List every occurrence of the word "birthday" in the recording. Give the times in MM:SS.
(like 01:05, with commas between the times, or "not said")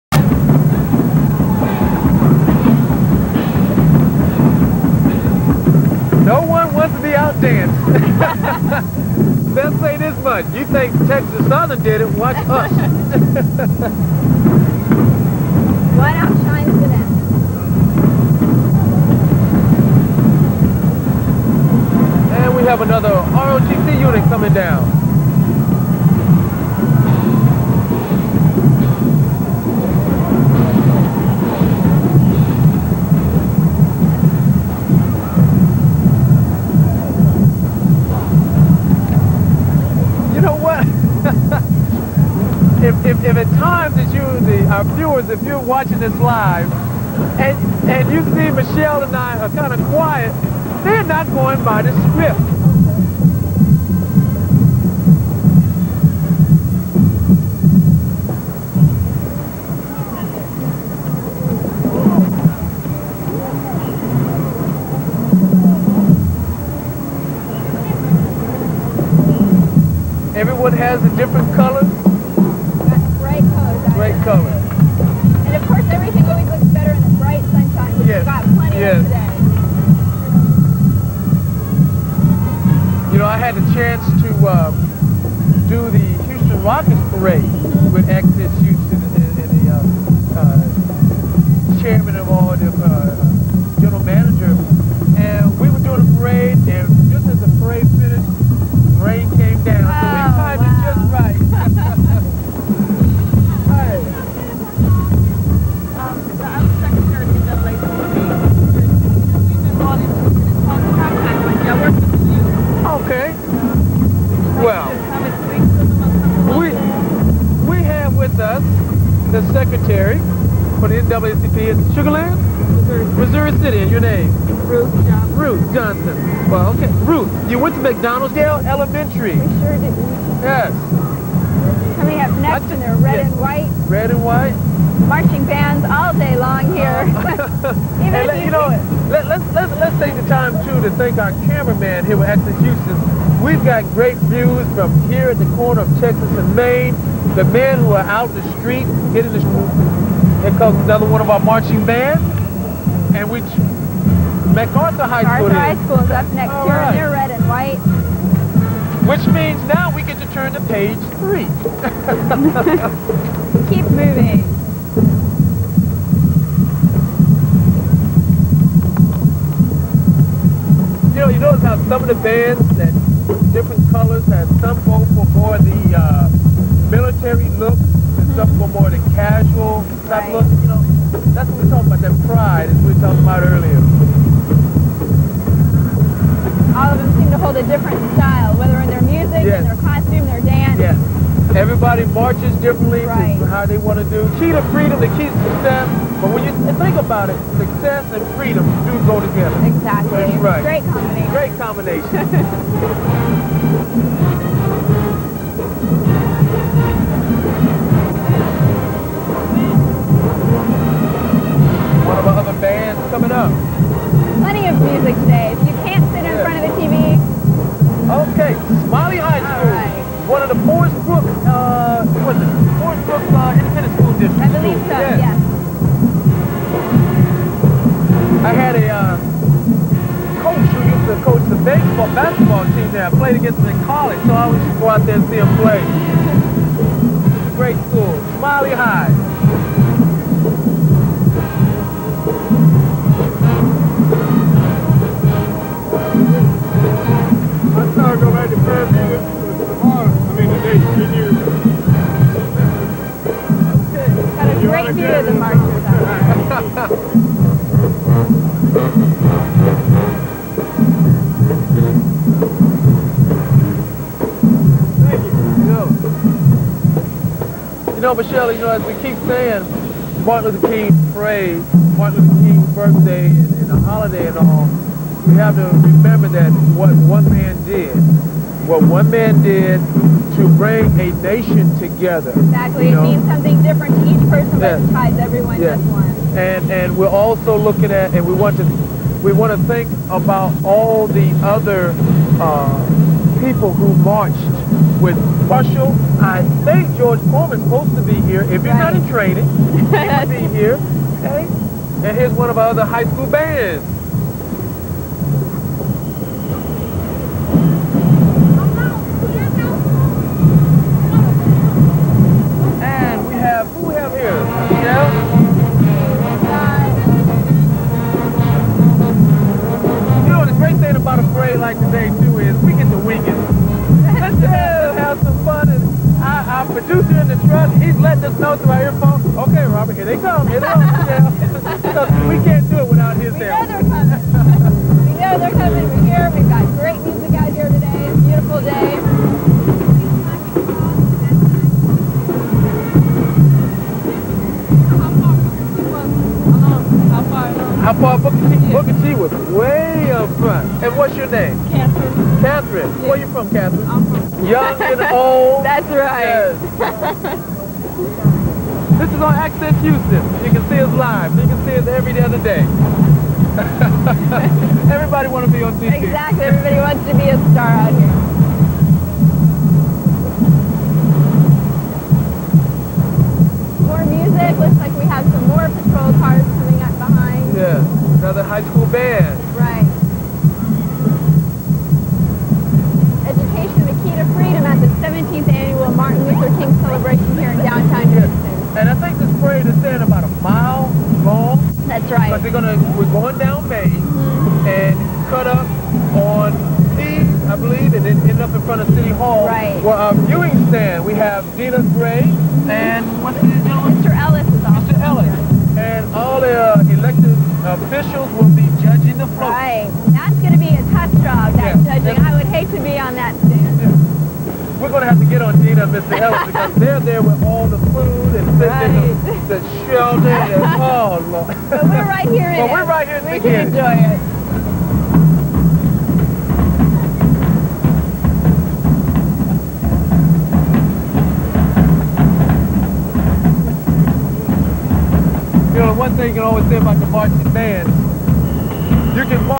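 04:32.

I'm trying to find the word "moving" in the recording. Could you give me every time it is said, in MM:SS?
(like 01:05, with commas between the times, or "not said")
02:43.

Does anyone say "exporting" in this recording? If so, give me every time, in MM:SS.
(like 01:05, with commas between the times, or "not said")
not said.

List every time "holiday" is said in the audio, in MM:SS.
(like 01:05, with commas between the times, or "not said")
04:33.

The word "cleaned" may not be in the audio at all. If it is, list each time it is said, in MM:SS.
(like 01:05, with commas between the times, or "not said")
not said.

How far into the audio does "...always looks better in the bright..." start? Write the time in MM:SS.
01:16.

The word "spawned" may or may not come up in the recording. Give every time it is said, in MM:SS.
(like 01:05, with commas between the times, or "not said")
not said.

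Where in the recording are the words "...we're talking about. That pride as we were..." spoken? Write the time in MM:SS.
03:01.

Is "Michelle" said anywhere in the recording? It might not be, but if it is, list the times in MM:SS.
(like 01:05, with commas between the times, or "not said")
00:48, 04:28.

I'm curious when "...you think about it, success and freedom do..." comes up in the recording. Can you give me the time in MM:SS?
03:16.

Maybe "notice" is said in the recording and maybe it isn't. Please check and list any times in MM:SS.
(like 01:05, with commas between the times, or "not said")
02:51.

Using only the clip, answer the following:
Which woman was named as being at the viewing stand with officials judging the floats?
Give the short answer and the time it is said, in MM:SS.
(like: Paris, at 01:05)
Dina Gray, at 06:41.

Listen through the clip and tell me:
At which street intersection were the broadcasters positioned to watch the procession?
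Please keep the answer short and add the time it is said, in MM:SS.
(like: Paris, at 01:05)
Texas and Main, at 02:26.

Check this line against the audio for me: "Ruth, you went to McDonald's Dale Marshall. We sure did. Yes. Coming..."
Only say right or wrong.
wrong.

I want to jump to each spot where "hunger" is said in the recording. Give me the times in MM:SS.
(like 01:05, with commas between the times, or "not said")
not said.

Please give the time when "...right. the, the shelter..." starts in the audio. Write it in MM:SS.
06:58.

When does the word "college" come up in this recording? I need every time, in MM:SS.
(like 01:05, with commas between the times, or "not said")
03:53.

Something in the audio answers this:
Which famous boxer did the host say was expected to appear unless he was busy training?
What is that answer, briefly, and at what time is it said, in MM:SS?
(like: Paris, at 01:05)
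George Foreman, at 04:56.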